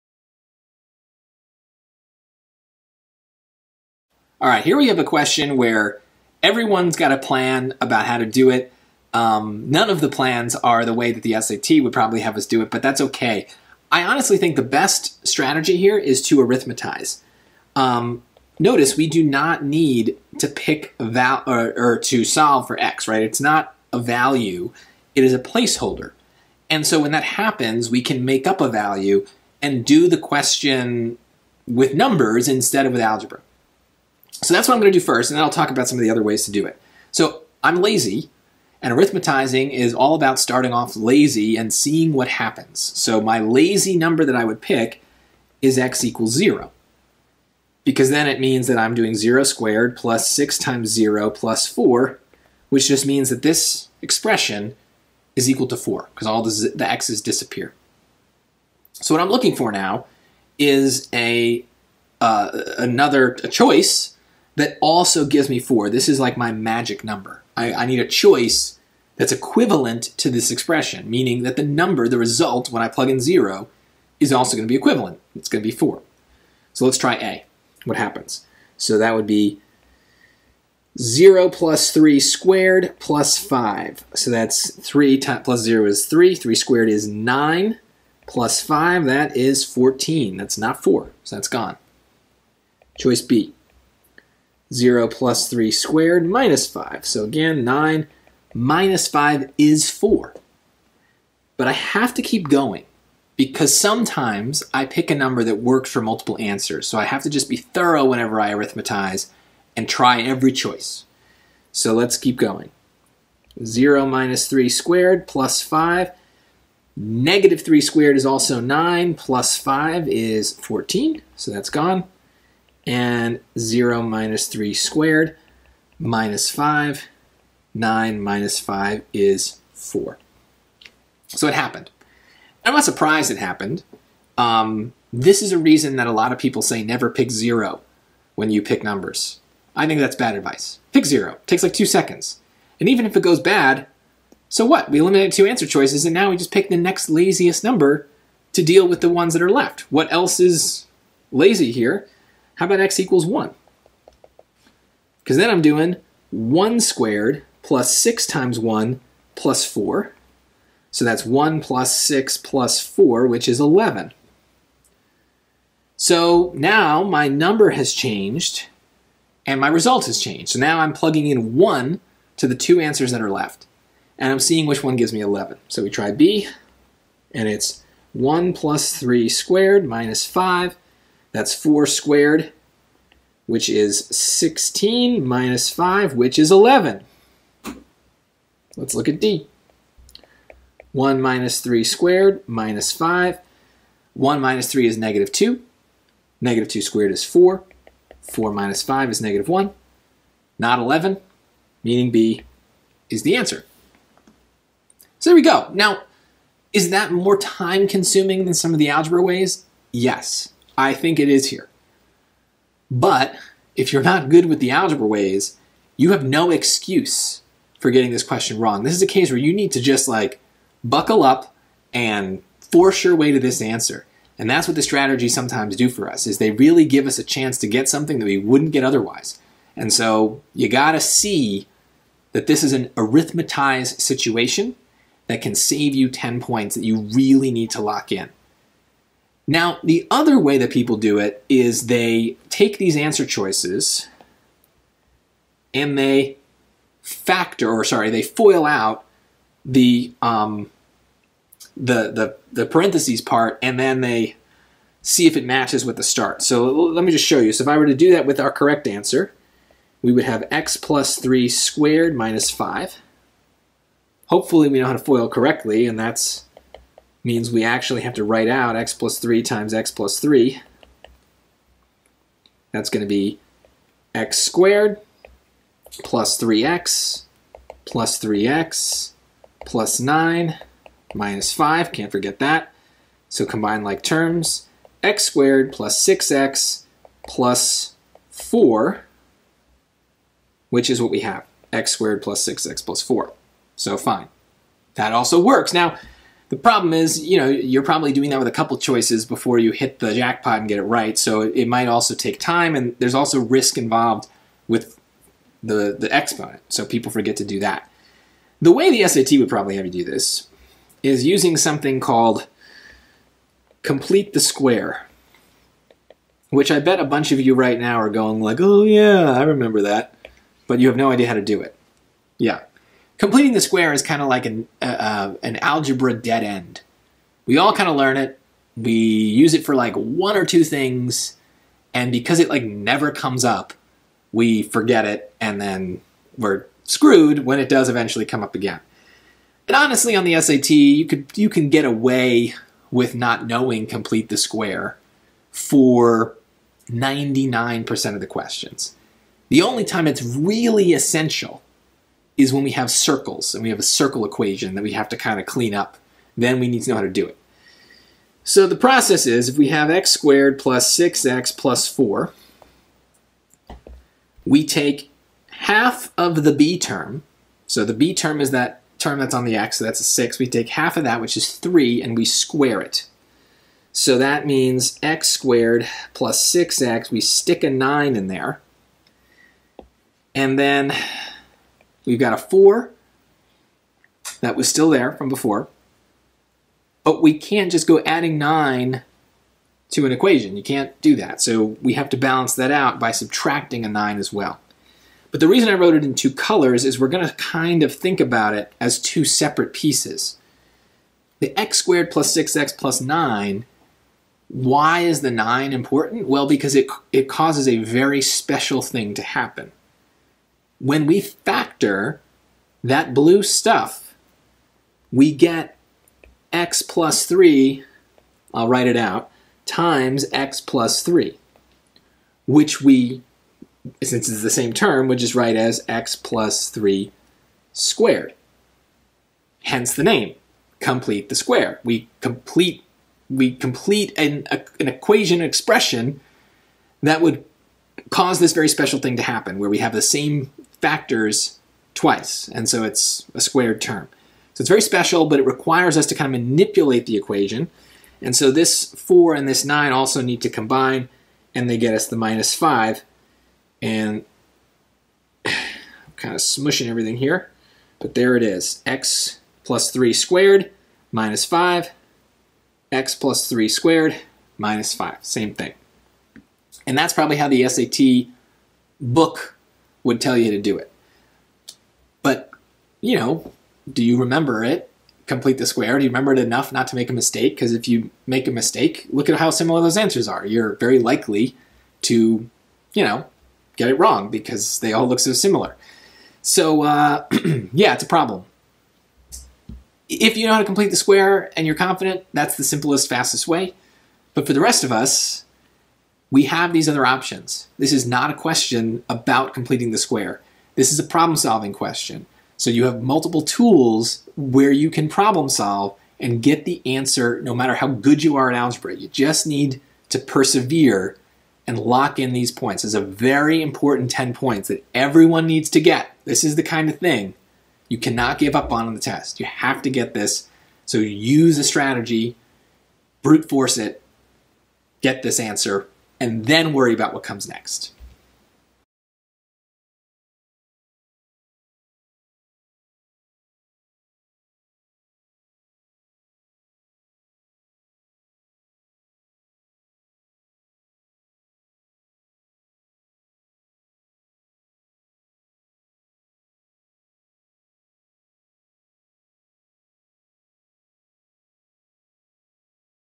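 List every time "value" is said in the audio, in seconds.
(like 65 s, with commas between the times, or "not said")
23 s, 28 s.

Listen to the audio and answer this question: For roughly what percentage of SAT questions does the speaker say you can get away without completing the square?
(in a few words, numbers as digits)
99%.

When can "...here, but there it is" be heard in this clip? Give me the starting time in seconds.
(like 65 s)
457 s.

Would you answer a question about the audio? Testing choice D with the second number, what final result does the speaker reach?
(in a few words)
-1.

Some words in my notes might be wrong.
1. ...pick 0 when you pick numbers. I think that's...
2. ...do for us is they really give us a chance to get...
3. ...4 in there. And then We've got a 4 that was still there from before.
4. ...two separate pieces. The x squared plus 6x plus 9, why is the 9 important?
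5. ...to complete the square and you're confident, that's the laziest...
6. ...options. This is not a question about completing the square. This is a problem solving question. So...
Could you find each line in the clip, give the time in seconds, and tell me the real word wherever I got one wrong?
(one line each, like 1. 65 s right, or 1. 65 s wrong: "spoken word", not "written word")
1. 137 s right
2. 225 s right
3. 377 s wrong: "9", not "4"
4. 398 s right
5. 490 s wrong: "simplest", not "laziest"
6. 497 s right.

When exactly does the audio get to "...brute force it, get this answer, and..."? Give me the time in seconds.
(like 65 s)
523 s.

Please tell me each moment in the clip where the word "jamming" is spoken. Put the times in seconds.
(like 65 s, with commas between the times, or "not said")
not said.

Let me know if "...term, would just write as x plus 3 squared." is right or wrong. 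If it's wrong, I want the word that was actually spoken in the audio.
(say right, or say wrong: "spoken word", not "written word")
right.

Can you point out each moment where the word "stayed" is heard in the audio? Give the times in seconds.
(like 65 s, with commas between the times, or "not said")
not said.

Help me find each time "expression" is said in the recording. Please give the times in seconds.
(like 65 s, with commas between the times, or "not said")
54 s, 70 s, 435 s.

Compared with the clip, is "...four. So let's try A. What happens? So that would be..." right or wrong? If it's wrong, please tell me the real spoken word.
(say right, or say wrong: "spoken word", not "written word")
right.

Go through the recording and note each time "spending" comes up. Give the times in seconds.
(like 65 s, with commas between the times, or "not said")
not said.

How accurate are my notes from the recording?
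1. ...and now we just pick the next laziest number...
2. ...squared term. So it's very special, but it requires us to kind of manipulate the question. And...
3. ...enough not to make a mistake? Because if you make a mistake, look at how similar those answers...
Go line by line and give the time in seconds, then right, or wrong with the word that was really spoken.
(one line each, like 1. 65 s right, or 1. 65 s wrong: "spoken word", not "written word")
1. 146 s right
2. 443 s wrong: "equation", not "question"
3. 476 s right.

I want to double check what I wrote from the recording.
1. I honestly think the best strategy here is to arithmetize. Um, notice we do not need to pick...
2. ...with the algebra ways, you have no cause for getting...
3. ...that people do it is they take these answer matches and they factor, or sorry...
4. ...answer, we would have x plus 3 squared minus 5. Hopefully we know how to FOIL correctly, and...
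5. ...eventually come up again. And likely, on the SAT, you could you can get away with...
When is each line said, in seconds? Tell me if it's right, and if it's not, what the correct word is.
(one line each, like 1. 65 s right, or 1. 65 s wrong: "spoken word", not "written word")
1. 13 s right
2. 214 s wrong: "excuse", not "cause"
3. 240 s wrong: "choices", not "matches"
4. 258 s right
5. 337 s wrong: "honestly", not "likely".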